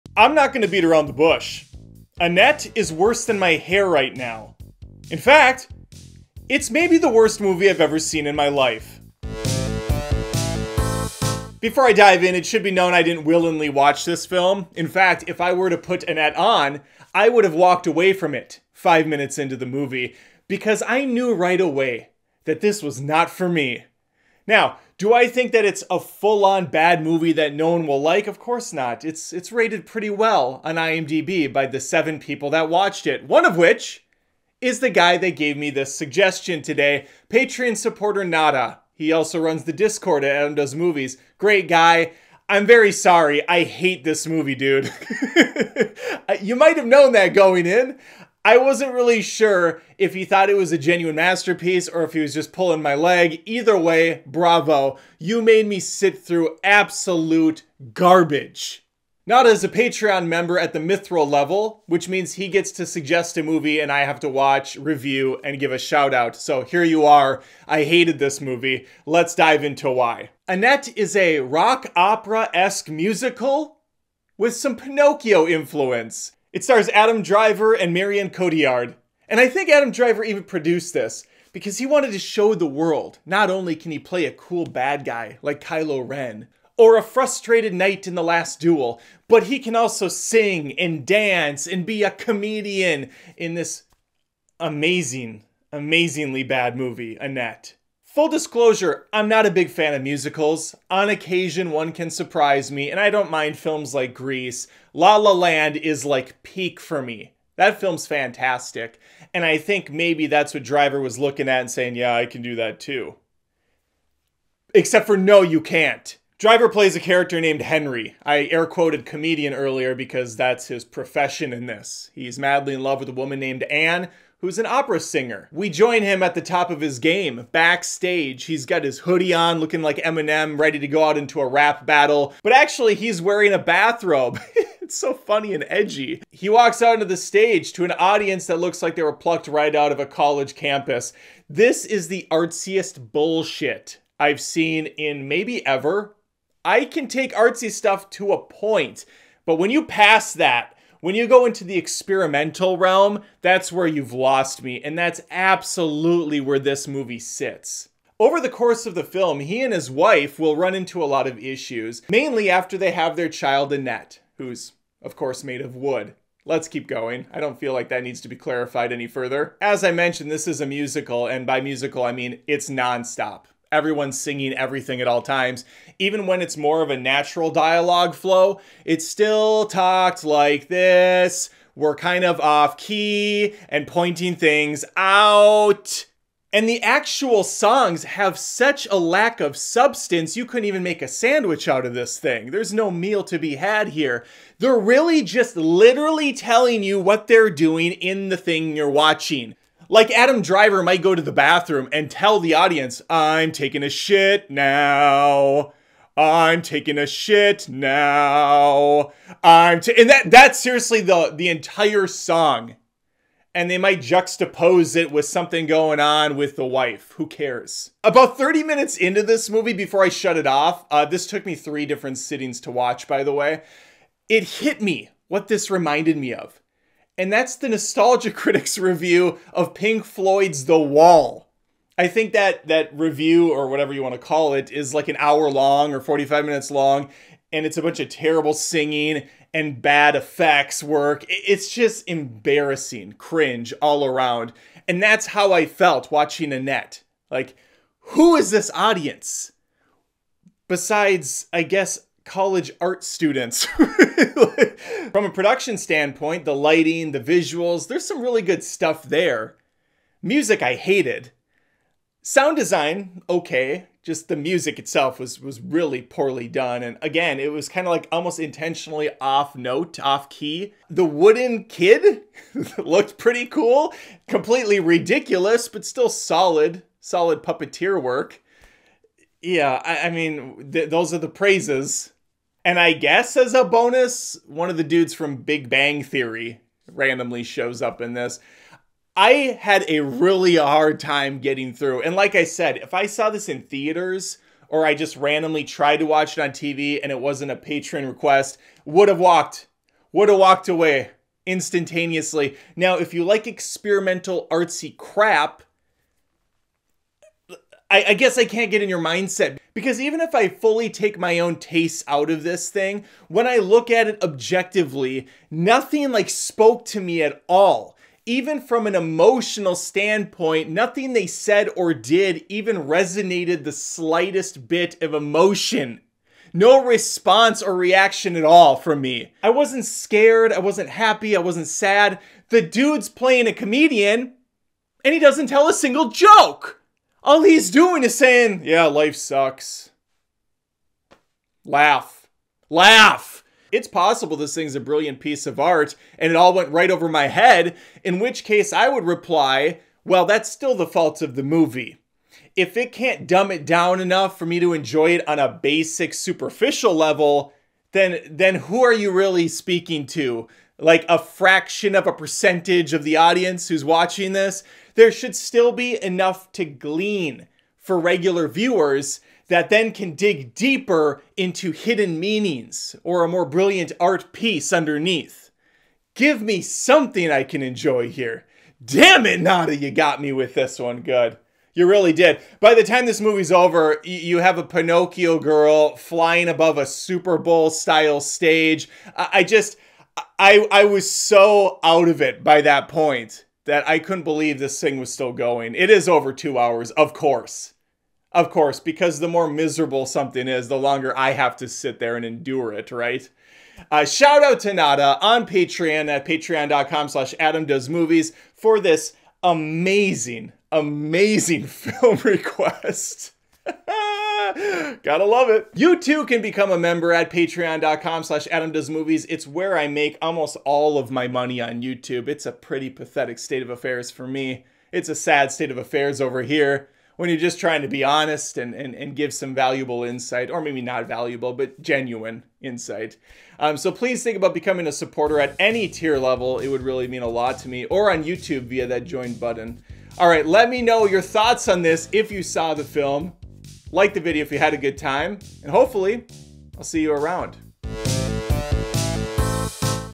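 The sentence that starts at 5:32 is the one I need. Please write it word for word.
The dude's playing a comedian and he doesn't tell a single joke.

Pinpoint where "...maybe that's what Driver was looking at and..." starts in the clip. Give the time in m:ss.
1:49.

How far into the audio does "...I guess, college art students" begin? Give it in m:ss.
4:11.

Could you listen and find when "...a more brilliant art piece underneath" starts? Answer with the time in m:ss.
6:13.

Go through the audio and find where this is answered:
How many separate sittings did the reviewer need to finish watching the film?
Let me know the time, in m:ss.
3:41.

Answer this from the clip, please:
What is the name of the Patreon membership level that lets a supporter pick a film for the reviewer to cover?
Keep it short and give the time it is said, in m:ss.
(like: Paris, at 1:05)
Mithril, at 1:00.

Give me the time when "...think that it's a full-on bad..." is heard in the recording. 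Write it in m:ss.
0:25.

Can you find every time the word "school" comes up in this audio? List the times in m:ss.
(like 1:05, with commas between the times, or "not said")
not said.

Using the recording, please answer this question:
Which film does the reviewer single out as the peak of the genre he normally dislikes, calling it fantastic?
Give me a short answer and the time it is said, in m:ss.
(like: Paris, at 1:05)
La La Land, at 1:44.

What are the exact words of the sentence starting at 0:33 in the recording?
One of which is the guy that gave me this suggestion today, Patreon supporter Nada.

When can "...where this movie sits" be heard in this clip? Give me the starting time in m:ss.
2:36.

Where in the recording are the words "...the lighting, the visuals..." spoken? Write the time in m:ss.
4:16.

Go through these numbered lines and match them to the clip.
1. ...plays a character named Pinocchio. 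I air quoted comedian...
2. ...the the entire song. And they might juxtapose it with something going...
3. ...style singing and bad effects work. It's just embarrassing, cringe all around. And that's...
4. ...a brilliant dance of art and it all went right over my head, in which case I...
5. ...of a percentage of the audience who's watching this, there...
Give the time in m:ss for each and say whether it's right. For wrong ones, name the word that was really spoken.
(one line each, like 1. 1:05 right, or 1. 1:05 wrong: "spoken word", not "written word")
1. 1:56 wrong: "Henry", not "Pinocchio"
2. 3:31 right
3. 3:58 wrong: "terrible", not "style"
4. 5:44 wrong: "piece", not "dance"
5. 6:01 right.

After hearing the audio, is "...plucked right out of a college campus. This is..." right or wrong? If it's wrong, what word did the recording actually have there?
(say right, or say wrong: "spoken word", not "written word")
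right.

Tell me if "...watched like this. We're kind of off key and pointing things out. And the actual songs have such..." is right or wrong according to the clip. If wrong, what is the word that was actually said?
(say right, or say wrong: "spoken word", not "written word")
wrong: "talked", not "watched".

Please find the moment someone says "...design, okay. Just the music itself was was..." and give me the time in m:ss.
4:22.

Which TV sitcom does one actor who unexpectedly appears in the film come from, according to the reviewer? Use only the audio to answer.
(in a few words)
Big Bang Theory.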